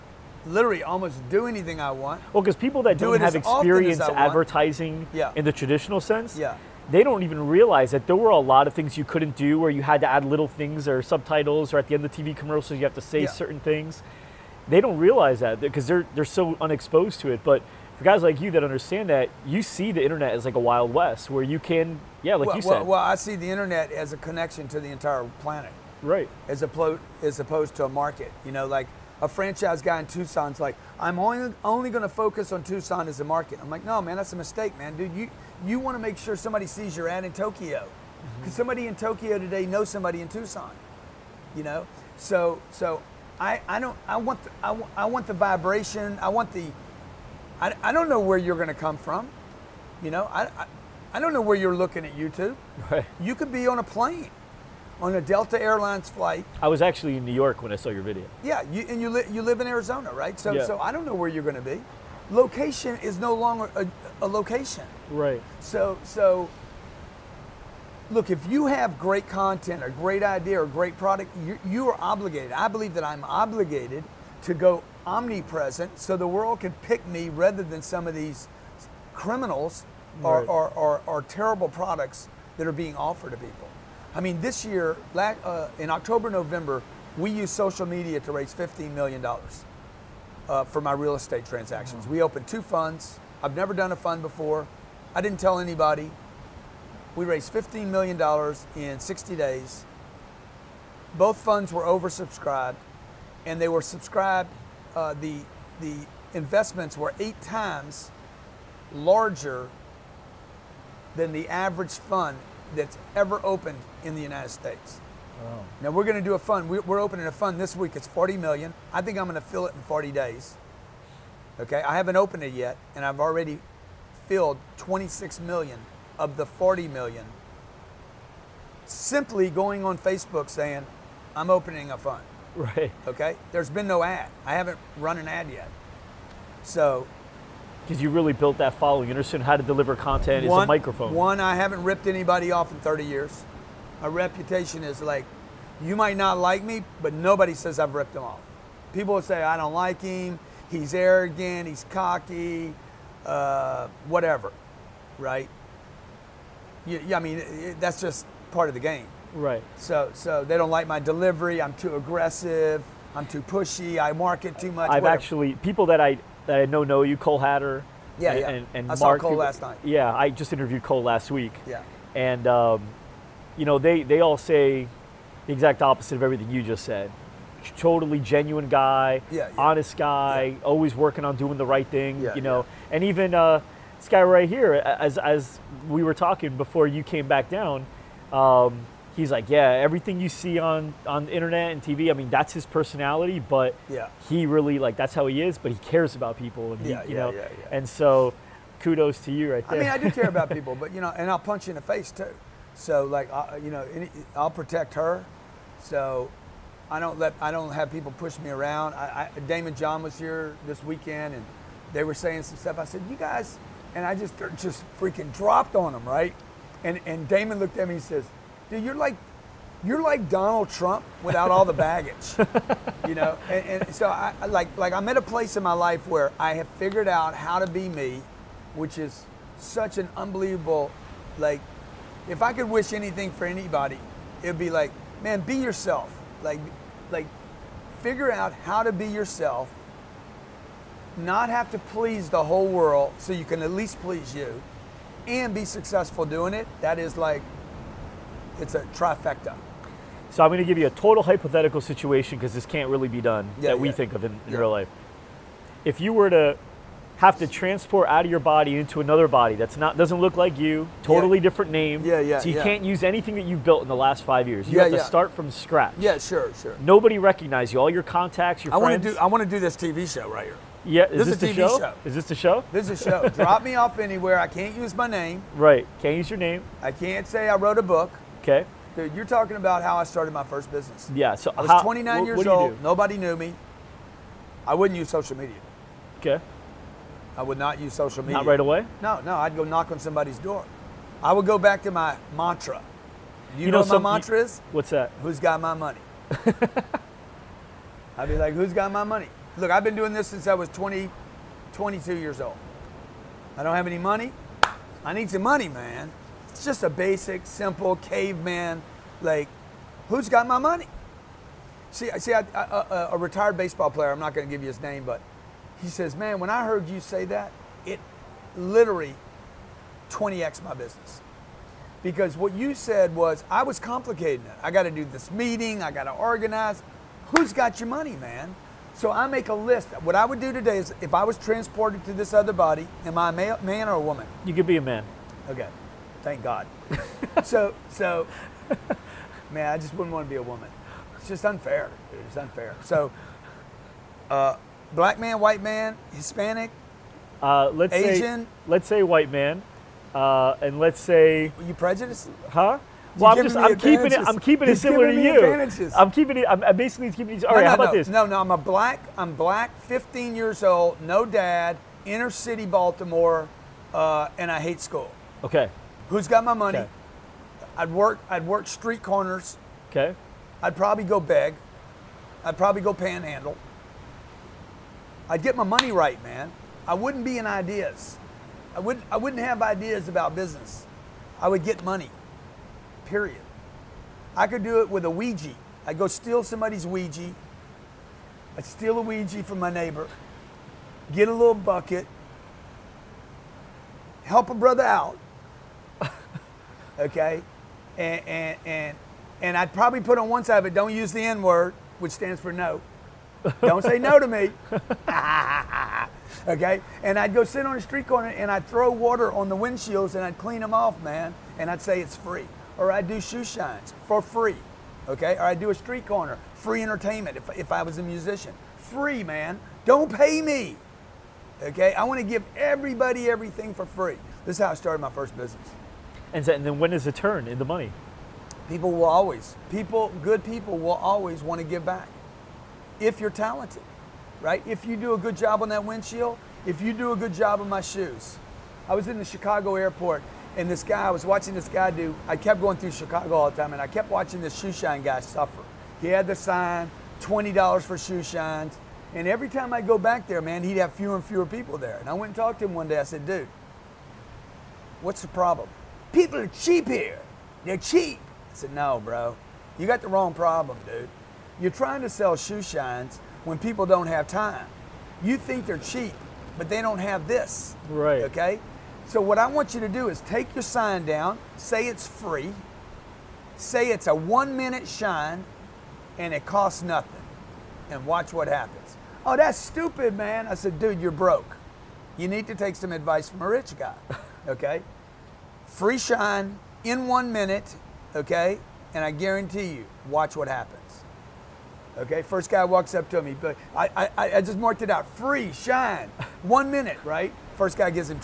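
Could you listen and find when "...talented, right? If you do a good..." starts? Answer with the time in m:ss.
7:13.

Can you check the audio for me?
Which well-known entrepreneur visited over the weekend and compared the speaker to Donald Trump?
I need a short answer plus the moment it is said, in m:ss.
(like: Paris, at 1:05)
Daymond John, at 3:29.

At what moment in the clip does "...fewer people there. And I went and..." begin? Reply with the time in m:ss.
7:31.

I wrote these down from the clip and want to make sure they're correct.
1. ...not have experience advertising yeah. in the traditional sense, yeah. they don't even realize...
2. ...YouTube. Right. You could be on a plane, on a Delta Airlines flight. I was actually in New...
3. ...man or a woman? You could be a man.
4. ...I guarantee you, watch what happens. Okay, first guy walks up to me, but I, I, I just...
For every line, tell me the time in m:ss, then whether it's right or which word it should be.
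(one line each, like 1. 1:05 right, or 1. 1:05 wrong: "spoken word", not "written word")
1. 0:03 right
2. 0:52 right
3. 5:33 right
4. 8:09 right.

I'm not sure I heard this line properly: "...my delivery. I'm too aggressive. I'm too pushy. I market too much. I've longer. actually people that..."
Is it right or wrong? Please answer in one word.
wrong.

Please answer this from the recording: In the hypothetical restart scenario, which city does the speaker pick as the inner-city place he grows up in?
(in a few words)
Baltimore.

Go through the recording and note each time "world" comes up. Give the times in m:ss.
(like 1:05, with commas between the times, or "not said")
1:16, 4:02.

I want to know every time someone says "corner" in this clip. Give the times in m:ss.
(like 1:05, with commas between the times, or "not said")
6:09, 6:48, 6:56.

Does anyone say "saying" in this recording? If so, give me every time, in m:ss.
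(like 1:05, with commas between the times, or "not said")
2:10, 3:32.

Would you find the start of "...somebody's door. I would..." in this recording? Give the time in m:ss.
4:49.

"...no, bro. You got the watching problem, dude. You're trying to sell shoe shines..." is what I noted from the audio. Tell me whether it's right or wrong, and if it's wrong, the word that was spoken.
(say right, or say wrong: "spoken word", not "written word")
wrong: "wrong", not "watching".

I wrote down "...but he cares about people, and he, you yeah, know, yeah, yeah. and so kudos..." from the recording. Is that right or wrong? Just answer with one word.
right.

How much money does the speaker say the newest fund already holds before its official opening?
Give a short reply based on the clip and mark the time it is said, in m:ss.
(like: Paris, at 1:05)
26 million, at 2:04.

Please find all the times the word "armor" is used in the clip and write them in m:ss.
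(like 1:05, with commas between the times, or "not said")
not said.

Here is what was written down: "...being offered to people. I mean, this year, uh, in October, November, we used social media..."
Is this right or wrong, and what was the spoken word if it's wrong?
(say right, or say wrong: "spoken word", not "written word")
right.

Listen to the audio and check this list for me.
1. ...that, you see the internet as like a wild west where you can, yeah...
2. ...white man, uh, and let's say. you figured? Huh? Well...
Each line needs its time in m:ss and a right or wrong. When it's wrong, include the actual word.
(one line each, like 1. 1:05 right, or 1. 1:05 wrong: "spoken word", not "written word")
1. 0:19 right
2. 5:49 wrong: "prejudiced", not "figured".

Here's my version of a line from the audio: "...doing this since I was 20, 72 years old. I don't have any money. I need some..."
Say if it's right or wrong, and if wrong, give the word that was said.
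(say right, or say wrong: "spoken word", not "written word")
wrong: "22", not "72".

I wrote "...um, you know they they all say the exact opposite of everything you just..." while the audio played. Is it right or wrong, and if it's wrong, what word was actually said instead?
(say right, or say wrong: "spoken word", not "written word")
right.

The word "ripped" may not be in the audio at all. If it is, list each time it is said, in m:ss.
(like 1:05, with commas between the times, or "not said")
2:21, 2:27.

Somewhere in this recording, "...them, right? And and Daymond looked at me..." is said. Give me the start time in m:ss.
3:35.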